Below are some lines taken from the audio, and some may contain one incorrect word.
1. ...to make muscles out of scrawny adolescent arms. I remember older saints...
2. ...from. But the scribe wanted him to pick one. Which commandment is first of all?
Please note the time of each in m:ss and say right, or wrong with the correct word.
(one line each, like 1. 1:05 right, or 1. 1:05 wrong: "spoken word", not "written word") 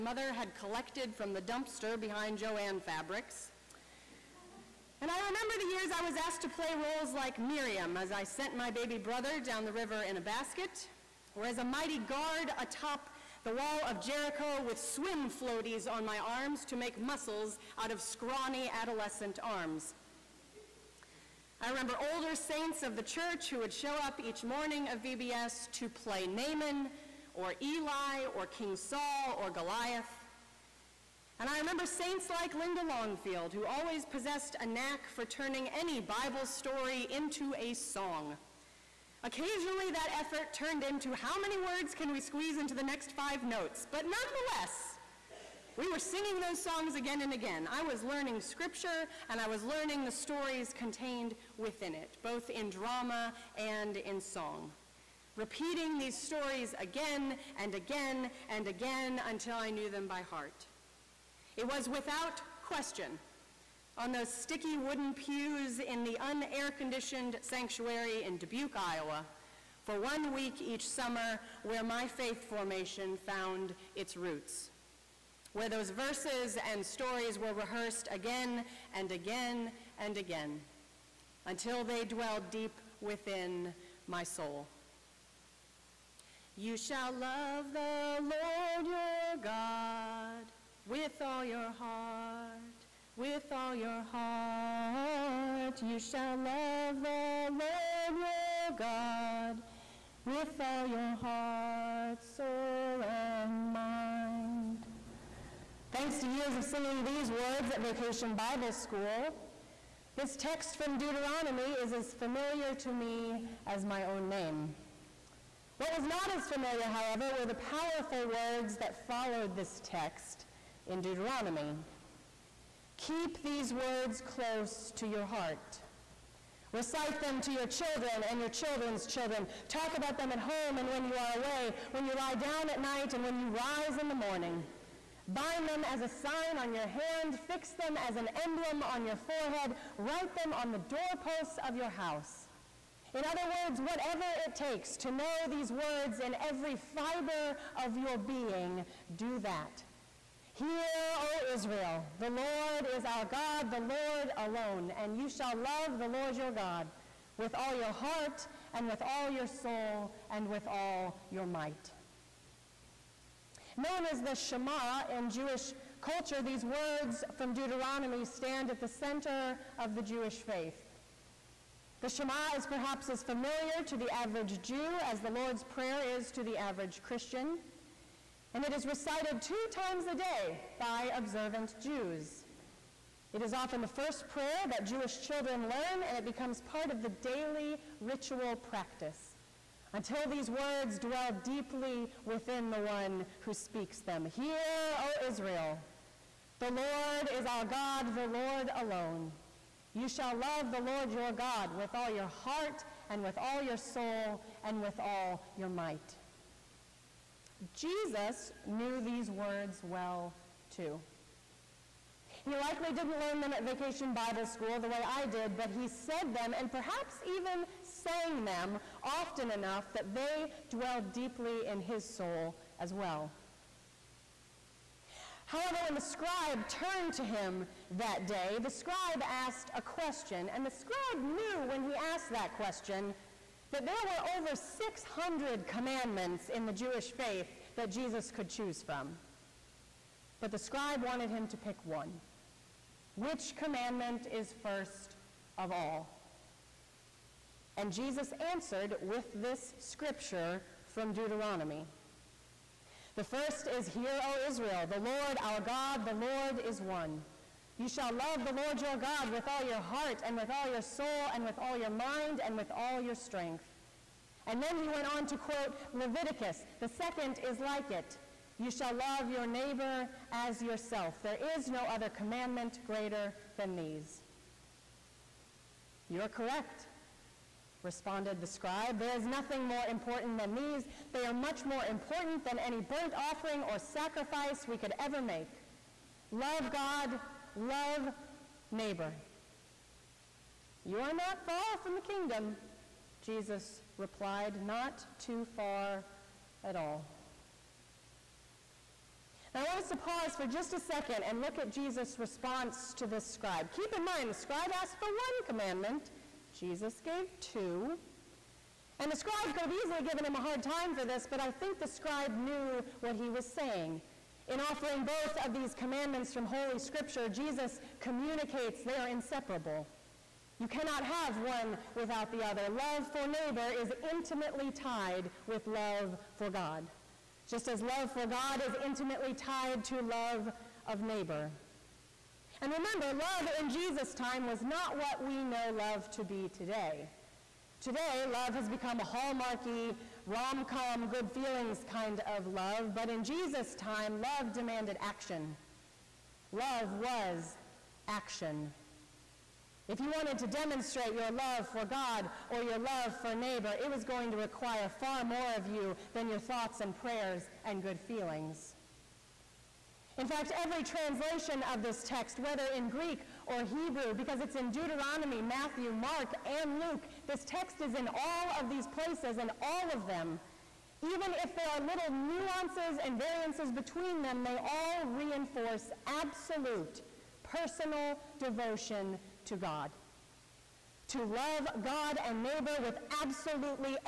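1. 0:16 right
2. 3:58 right.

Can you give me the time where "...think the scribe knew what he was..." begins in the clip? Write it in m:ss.
5:11.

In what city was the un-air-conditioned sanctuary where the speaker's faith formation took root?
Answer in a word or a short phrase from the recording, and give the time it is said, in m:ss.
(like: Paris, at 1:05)
Dubuque, Iowa, at 1:08.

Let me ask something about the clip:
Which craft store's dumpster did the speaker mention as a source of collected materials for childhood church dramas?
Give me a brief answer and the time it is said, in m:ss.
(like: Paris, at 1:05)
Jo-Ann Fabrics, at 0:02.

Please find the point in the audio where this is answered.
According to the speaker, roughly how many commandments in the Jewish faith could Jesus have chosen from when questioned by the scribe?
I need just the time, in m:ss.
3:54.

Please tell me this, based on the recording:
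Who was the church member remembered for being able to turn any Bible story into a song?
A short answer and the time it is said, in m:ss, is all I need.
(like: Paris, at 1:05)
Linda Longfield, at 0:32.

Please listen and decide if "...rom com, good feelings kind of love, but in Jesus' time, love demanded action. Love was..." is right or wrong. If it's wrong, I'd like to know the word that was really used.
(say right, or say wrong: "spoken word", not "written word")
right.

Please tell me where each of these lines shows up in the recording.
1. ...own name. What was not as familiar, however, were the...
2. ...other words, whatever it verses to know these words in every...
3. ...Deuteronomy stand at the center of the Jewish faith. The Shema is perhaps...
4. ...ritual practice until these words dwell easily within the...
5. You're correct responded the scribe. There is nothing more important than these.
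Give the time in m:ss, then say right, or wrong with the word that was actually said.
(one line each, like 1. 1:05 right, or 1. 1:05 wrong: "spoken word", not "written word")
1. 1:54 right
2. 2:23 wrong: "takes", not "verses"
3. 2:47 right
4. 3:07 wrong: "deeply", not "easily"
5. 4:36 right.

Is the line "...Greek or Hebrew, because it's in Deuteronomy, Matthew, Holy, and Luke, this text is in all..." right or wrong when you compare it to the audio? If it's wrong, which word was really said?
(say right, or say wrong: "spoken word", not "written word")
wrong: "Mark", not "Holy".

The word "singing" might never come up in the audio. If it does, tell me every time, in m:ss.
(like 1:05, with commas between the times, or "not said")
0:45, 1:46.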